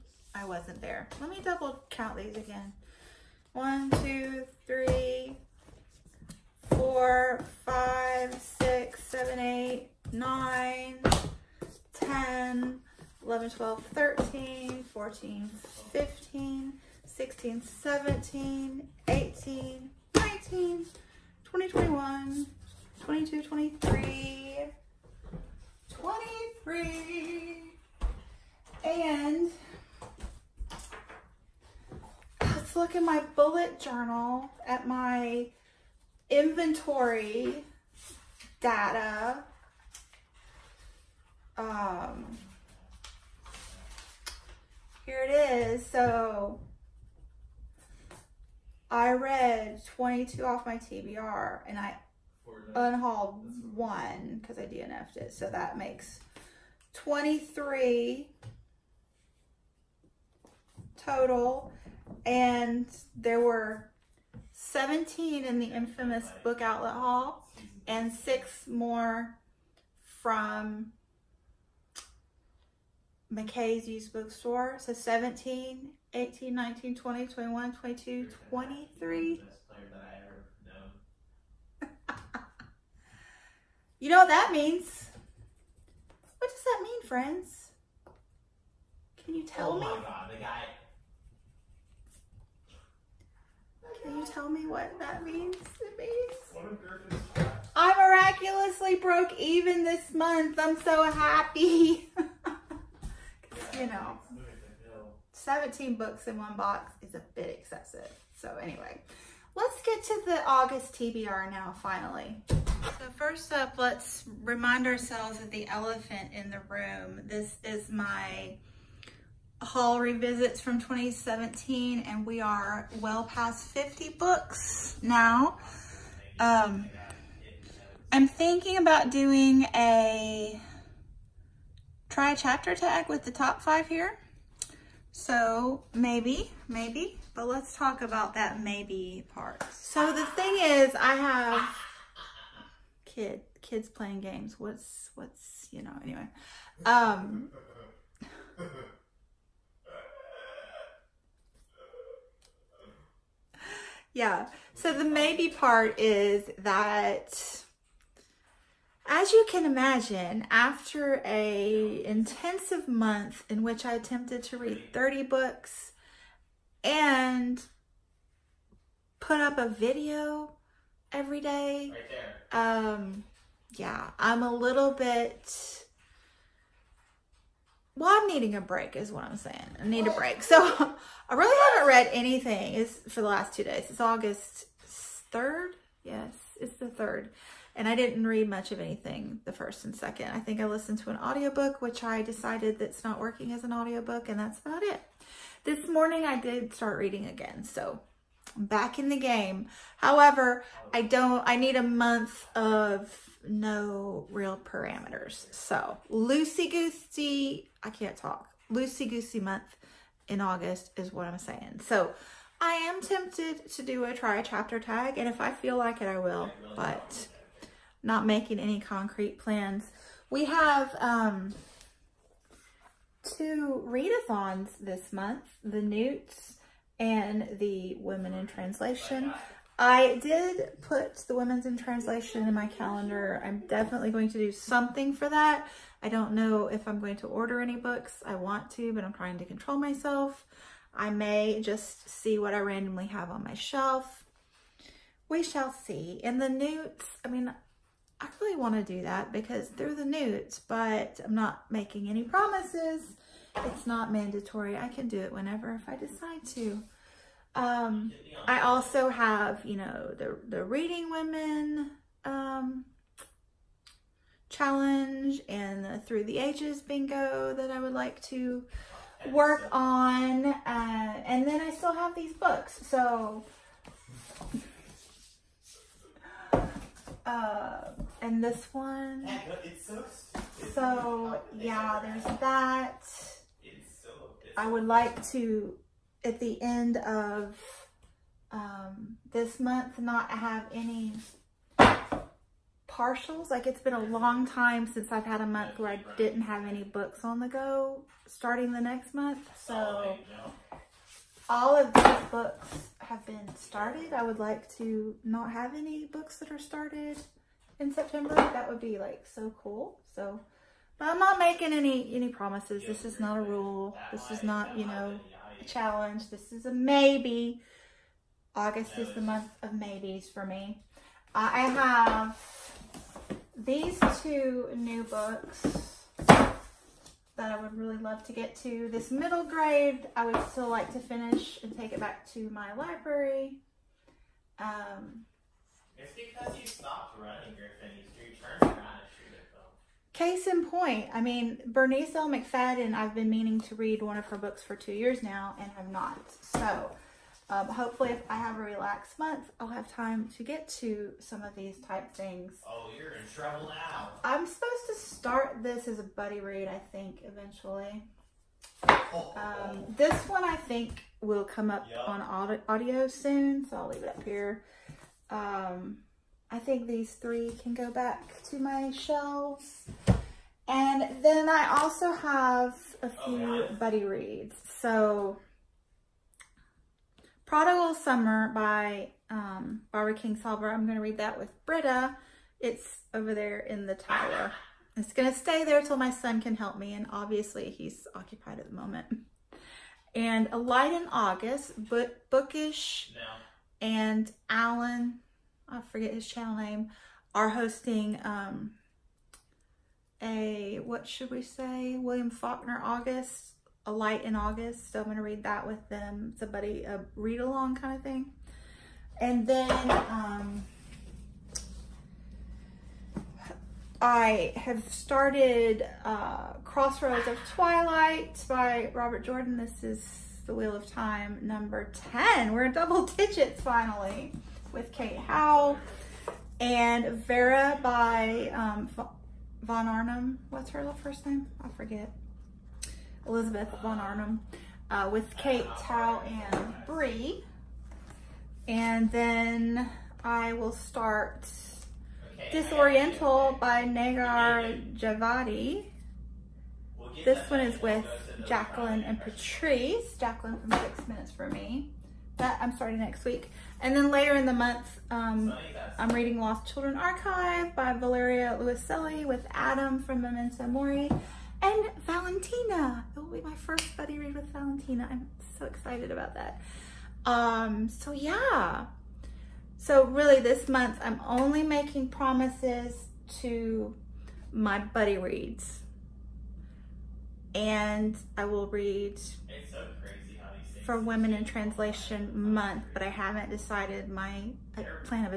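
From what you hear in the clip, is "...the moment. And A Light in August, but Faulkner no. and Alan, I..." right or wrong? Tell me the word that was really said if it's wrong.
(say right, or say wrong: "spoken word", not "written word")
wrong: "Bookish", not "Faulkner".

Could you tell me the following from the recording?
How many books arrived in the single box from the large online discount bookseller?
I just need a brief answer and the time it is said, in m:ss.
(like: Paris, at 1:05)
17, at 1:04.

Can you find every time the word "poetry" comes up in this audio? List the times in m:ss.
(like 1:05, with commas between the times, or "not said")
not said.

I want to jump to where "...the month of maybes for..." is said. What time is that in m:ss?
5:19.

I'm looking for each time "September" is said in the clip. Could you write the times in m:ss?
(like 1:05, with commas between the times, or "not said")
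5:07.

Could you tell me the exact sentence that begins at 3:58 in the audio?
I want to, but I'm trying to control myself.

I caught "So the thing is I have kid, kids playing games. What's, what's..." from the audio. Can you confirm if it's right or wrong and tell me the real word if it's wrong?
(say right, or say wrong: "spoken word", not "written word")
right.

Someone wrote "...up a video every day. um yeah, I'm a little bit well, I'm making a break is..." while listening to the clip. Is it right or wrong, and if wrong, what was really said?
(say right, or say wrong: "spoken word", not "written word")
wrong: "needing", not "making".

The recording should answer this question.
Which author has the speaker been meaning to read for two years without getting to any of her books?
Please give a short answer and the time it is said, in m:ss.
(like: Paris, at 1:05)
Bernice L. McFadden, at 5:41.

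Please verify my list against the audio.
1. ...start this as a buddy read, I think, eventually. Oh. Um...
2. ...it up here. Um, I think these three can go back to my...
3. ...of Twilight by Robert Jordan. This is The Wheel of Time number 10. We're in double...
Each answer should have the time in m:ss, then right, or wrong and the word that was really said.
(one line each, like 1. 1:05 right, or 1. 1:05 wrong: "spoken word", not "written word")
1. 5:54 right
2. 6:04 right
3. 6:57 right.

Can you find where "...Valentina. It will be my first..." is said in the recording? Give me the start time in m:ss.
7:42.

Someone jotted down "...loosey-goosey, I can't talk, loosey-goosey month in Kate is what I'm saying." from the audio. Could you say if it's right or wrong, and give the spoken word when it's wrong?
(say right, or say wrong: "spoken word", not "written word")
wrong: "August", not "Kate".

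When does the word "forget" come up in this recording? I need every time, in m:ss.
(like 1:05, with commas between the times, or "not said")
6:35, 7:11.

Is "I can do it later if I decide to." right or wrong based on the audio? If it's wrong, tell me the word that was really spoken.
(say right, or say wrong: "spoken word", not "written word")
wrong: "whenever", not "later".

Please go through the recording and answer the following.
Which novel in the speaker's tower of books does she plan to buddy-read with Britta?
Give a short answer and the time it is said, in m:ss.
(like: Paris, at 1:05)
Prodigal Summer, at 6:17.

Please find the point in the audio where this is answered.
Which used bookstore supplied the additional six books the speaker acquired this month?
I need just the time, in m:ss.
1:13.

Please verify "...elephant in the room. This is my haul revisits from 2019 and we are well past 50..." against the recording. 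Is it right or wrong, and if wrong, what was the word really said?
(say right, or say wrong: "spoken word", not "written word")
wrong: "2017", not "2019".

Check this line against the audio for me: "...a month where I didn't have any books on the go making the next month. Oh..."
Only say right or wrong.
wrong.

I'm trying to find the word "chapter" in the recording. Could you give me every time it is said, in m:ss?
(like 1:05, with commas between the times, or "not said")
2:12, 3:34.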